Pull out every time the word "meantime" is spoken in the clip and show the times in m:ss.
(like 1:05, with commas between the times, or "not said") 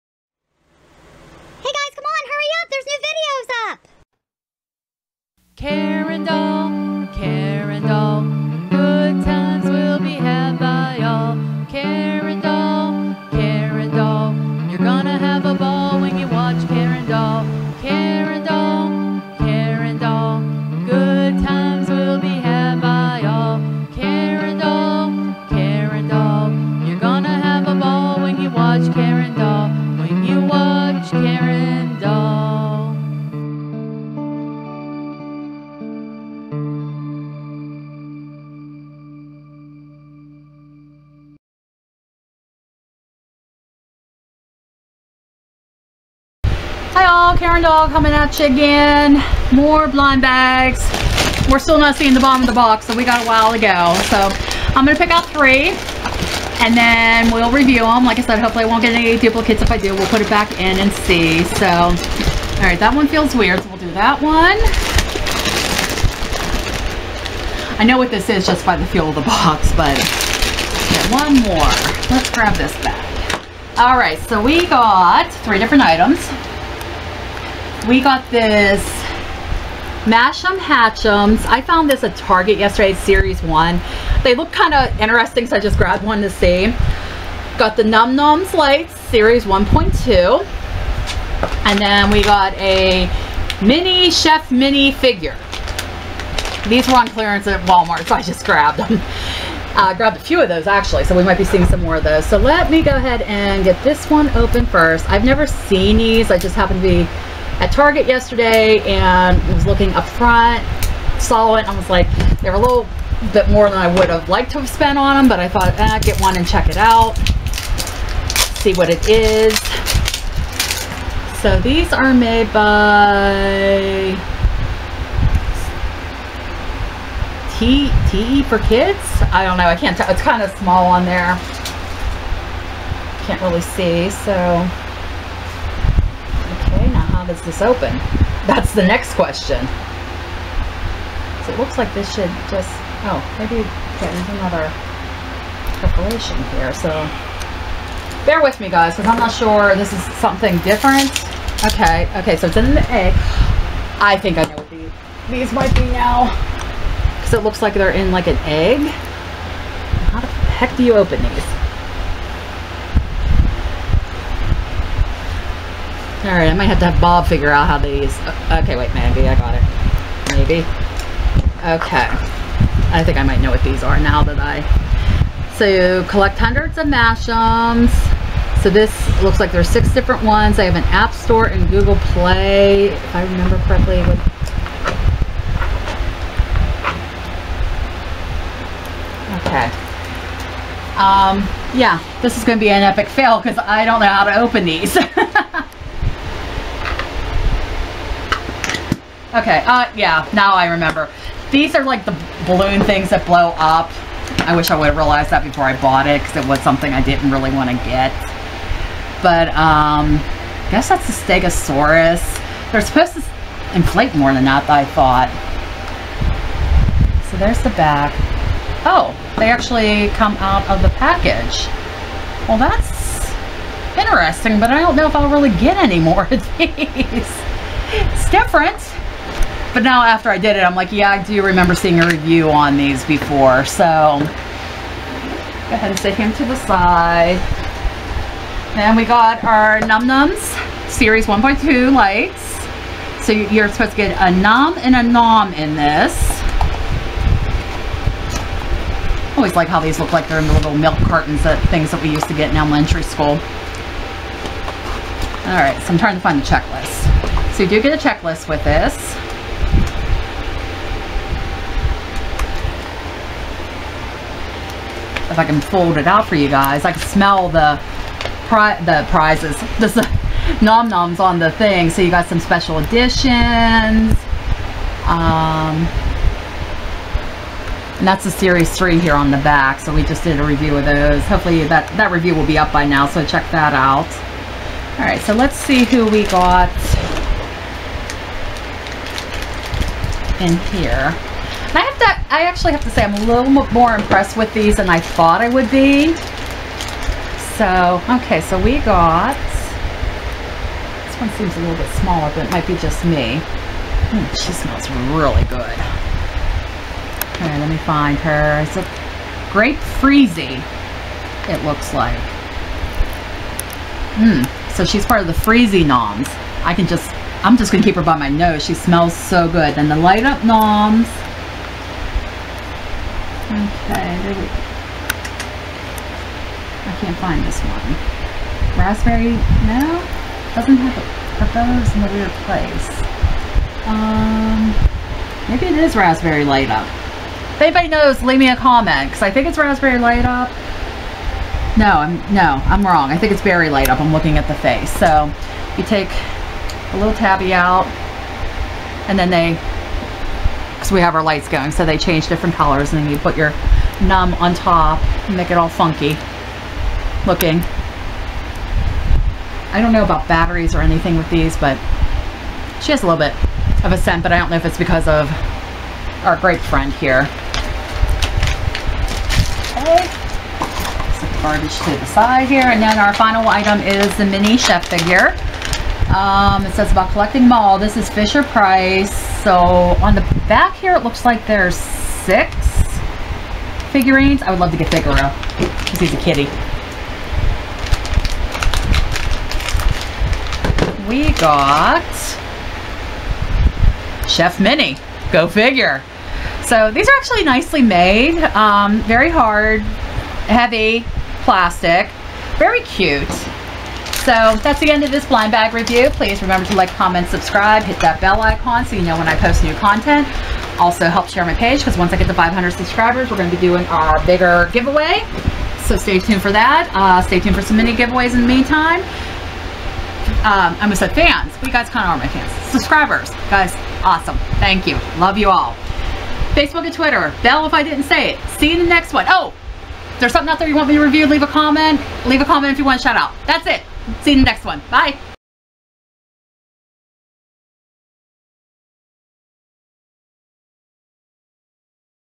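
6:58.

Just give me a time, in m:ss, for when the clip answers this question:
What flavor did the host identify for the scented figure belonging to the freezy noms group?
5:09.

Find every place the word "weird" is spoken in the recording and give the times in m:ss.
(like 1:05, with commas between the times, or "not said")
1:03, 5:32.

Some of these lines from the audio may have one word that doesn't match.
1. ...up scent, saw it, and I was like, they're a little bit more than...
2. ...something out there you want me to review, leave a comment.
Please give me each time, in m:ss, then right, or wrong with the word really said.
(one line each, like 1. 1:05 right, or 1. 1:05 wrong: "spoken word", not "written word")
1. 1:49 wrong: "front", not "scent"
2. 7:10 right.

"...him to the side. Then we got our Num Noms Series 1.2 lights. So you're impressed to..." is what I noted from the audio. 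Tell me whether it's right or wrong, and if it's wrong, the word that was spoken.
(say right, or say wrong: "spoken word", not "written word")
wrong: "supposed", not "impressed".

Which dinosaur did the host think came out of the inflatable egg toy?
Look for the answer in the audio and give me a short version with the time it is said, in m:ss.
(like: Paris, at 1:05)
Stegosaurus, at 3:31.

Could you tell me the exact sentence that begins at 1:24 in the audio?
They look kind of interesting, so I just grabbed one to see.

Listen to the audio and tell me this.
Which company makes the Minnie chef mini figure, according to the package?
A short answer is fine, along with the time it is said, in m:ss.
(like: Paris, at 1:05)
Fisher Price, at 6:17.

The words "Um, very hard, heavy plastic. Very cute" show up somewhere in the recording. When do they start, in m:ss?
6:38.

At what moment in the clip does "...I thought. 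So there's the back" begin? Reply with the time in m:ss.
3:34.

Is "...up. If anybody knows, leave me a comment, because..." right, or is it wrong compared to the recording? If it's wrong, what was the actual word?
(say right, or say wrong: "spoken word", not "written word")
right.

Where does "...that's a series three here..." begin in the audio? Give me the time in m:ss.
4:38.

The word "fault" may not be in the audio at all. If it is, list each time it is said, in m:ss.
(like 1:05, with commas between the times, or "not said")
not said.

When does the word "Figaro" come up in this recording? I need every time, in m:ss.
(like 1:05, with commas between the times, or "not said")
6:24.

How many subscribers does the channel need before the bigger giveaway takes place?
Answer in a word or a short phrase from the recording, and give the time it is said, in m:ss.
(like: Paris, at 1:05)
500, at 6:52.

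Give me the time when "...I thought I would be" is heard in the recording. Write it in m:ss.
4:54.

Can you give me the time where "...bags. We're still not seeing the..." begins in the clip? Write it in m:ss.
0:50.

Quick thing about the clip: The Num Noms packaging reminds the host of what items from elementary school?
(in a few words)
Milk cartons.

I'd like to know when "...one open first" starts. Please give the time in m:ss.
1:44.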